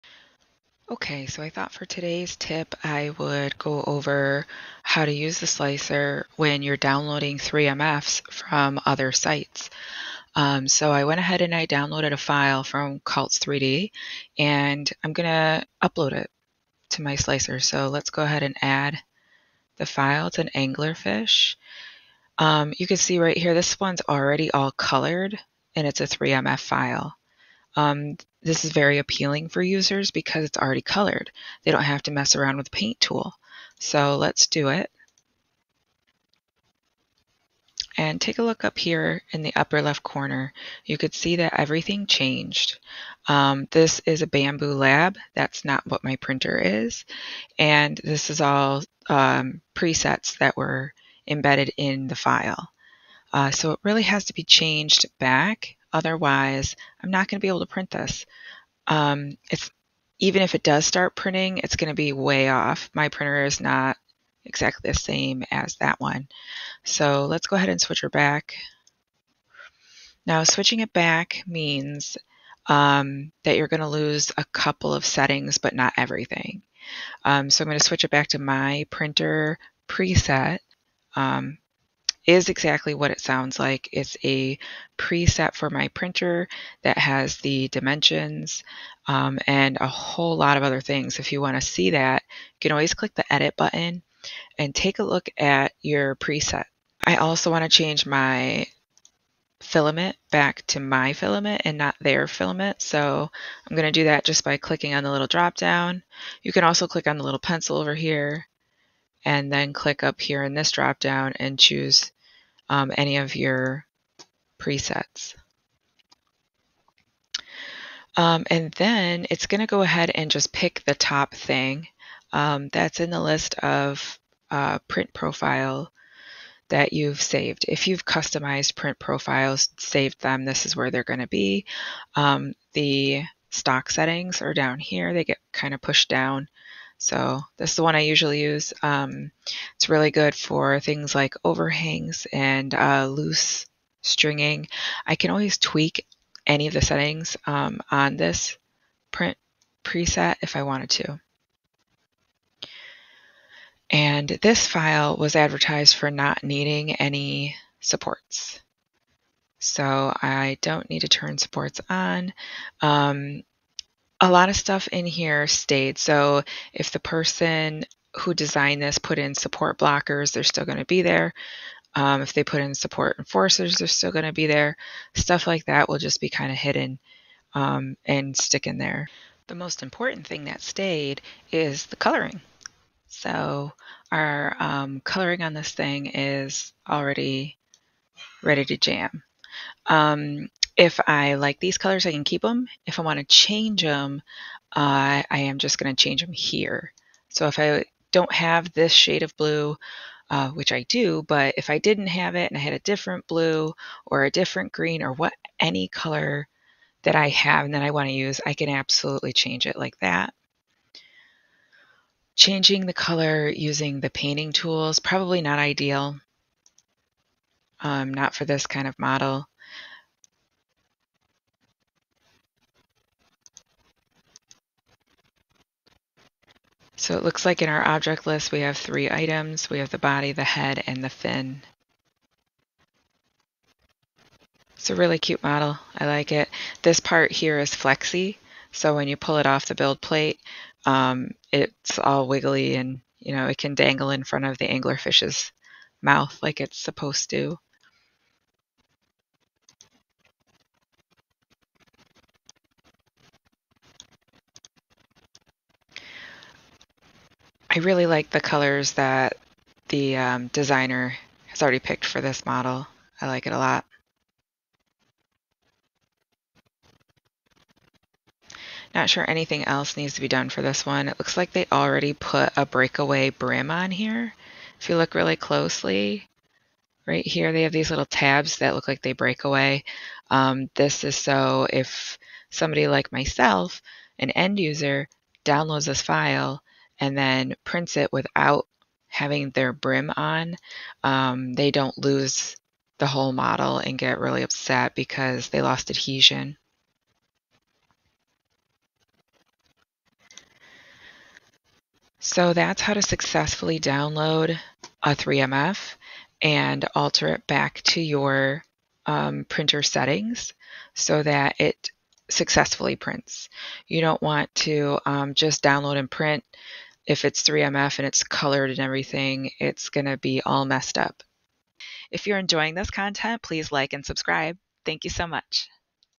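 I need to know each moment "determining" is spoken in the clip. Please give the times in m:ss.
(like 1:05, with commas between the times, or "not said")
not said.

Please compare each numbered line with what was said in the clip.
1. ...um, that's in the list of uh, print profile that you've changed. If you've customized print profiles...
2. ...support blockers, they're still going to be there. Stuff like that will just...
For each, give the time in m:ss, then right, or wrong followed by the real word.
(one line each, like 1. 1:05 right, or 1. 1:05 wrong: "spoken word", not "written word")
1. 2:02 wrong: "saved", not "changed"
2. 2:52 wrong: "enforcers", not "blockers".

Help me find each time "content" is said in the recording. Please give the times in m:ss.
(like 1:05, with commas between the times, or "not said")
5:22.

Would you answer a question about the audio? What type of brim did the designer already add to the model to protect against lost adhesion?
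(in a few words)
Breakaway brim.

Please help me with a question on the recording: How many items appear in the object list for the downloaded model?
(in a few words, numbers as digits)
3.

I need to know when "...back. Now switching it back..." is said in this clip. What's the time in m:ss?
1:08.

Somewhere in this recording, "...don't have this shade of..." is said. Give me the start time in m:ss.
3:18.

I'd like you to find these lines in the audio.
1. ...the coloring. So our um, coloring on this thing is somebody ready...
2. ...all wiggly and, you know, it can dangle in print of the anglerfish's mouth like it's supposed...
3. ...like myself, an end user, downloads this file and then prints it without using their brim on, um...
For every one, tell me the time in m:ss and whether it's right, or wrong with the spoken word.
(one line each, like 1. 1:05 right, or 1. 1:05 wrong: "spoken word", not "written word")
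1. 3:01 wrong: "already", not "somebody"
2. 4:01 wrong: "front", not "print"
3. 4:42 wrong: "having", not "using".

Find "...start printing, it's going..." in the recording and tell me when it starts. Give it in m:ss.
1:00.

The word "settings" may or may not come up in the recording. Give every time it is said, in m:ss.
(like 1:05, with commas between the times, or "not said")
1:15, 2:13, 2:26, 5:09.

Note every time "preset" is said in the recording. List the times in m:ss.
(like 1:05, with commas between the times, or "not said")
0:49, 1:19, 1:24, 1:36, 1:54, 2:29.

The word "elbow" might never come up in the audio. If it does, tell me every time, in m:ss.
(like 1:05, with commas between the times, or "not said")
not said.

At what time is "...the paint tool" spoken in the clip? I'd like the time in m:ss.
0:32.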